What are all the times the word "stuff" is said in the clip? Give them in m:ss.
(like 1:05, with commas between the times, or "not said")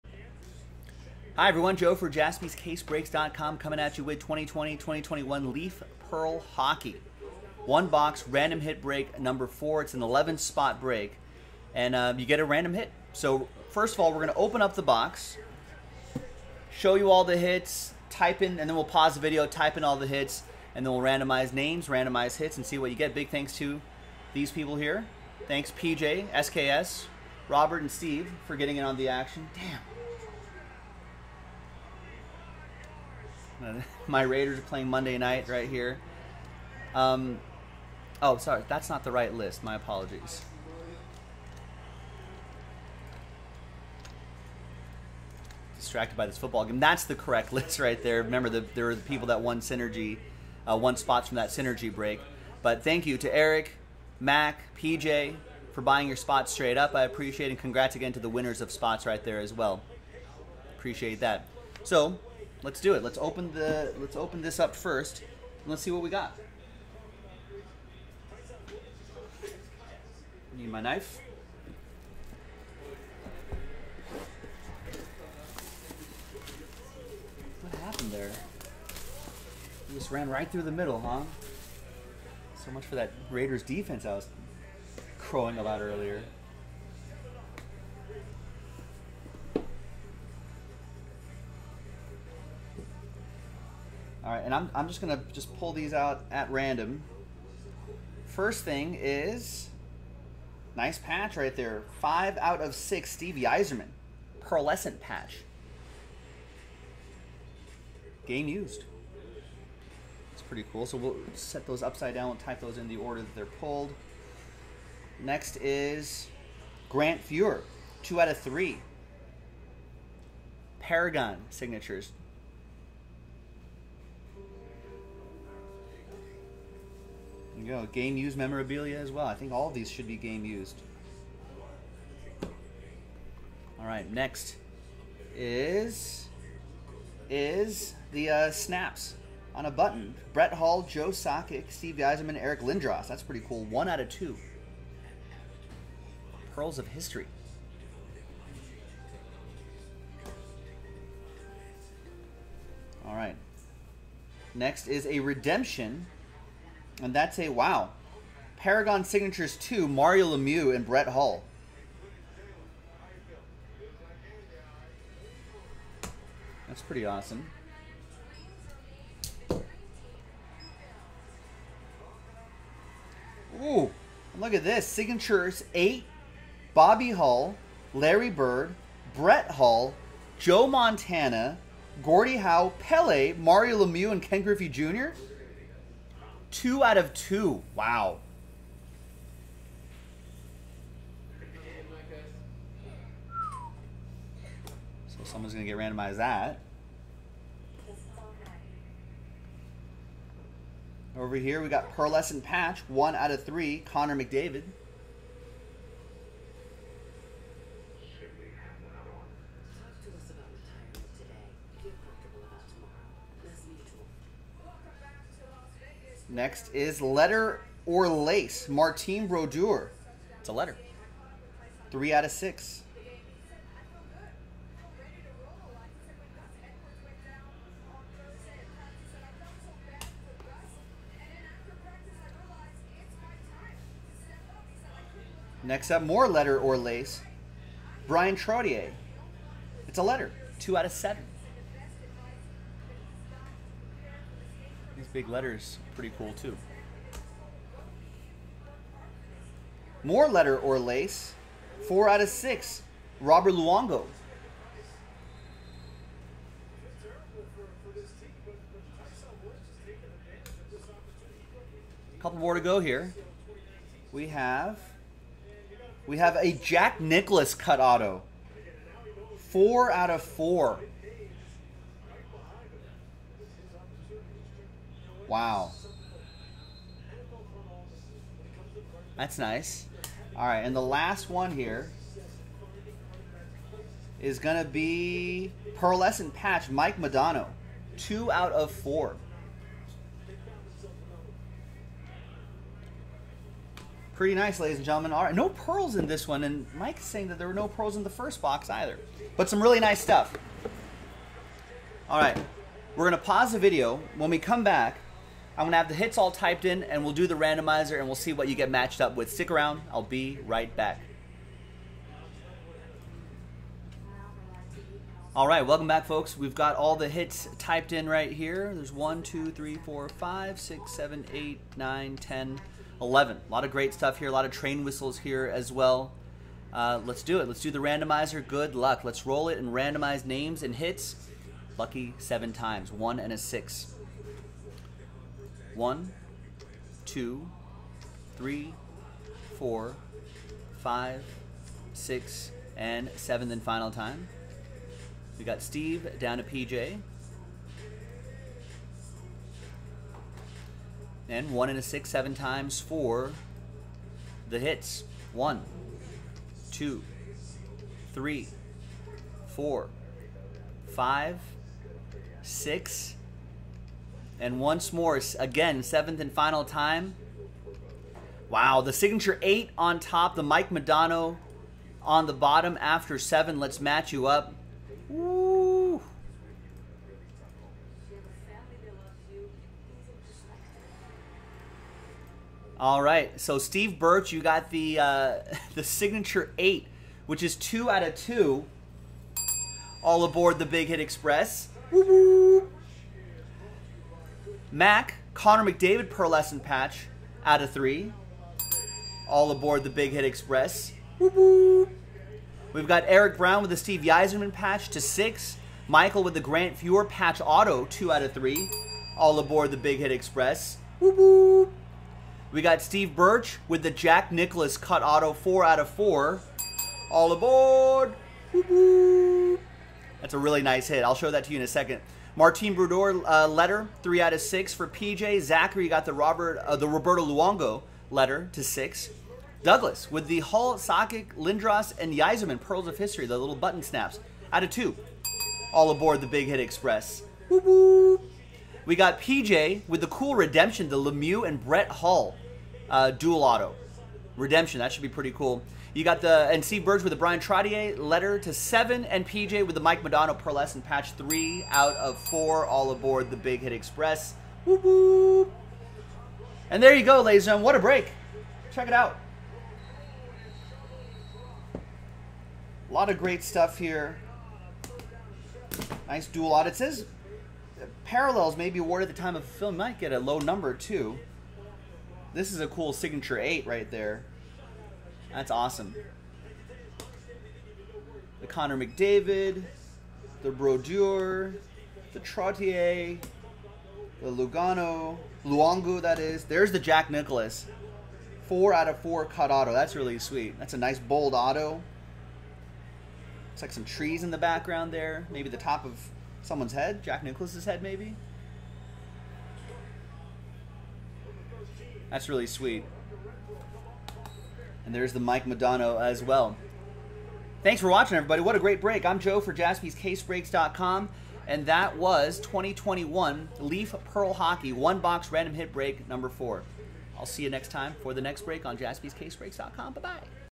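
5:00, 5:23, 7:43.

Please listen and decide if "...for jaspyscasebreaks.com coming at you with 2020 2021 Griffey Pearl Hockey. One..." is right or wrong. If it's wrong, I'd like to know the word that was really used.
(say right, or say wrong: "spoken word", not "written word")
wrong: "Leaf", not "Griffey".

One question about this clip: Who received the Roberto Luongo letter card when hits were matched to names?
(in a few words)
Zachary.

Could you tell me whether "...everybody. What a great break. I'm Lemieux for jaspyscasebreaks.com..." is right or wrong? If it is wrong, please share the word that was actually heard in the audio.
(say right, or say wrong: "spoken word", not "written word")
wrong: "Joe", not "Lemieux".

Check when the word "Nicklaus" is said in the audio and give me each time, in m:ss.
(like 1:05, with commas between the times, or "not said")
4:27, 6:54, 8:07, 8:17.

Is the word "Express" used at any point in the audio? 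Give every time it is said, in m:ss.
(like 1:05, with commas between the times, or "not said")
6:30, 6:40, 6:50, 7:16, 7:33.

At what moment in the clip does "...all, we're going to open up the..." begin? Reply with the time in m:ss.
0:14.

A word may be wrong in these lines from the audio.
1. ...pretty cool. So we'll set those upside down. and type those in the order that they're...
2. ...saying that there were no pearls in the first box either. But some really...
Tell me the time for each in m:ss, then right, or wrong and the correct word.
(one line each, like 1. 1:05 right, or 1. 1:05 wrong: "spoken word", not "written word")
1. 1:50 right
2. 4:57 right.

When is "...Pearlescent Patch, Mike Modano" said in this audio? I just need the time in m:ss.
4:45.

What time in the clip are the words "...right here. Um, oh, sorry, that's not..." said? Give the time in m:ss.
0:35.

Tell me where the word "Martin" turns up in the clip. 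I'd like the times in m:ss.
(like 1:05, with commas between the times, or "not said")
3:38, 7:02.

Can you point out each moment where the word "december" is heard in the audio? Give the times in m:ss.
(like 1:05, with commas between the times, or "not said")
not said.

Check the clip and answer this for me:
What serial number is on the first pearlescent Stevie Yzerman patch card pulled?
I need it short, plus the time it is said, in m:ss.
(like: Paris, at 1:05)
5 out of 6, at 1:41.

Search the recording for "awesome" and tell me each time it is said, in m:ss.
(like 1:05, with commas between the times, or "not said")
2:47, 7:55.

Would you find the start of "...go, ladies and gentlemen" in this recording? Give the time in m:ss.
7:37.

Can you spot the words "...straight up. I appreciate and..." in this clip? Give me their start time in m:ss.
0:56.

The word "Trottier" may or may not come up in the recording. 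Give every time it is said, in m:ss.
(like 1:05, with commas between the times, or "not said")
3:58, 7:27, 8:02.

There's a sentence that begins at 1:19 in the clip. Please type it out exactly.
We just ran right through the middle, huh?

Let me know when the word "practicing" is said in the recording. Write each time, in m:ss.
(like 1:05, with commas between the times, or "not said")
not said.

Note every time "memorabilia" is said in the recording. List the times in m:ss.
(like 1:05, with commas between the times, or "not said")
2:08.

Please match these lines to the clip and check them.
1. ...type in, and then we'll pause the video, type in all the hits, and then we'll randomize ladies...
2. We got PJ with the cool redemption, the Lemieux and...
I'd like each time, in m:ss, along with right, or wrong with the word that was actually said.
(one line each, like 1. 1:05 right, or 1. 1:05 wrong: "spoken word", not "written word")
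1. 0:18 wrong: "names", not "ladies"
2. 7:18 right.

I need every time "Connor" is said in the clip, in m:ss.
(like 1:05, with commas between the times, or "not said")
3:23, 6:35, 7:58.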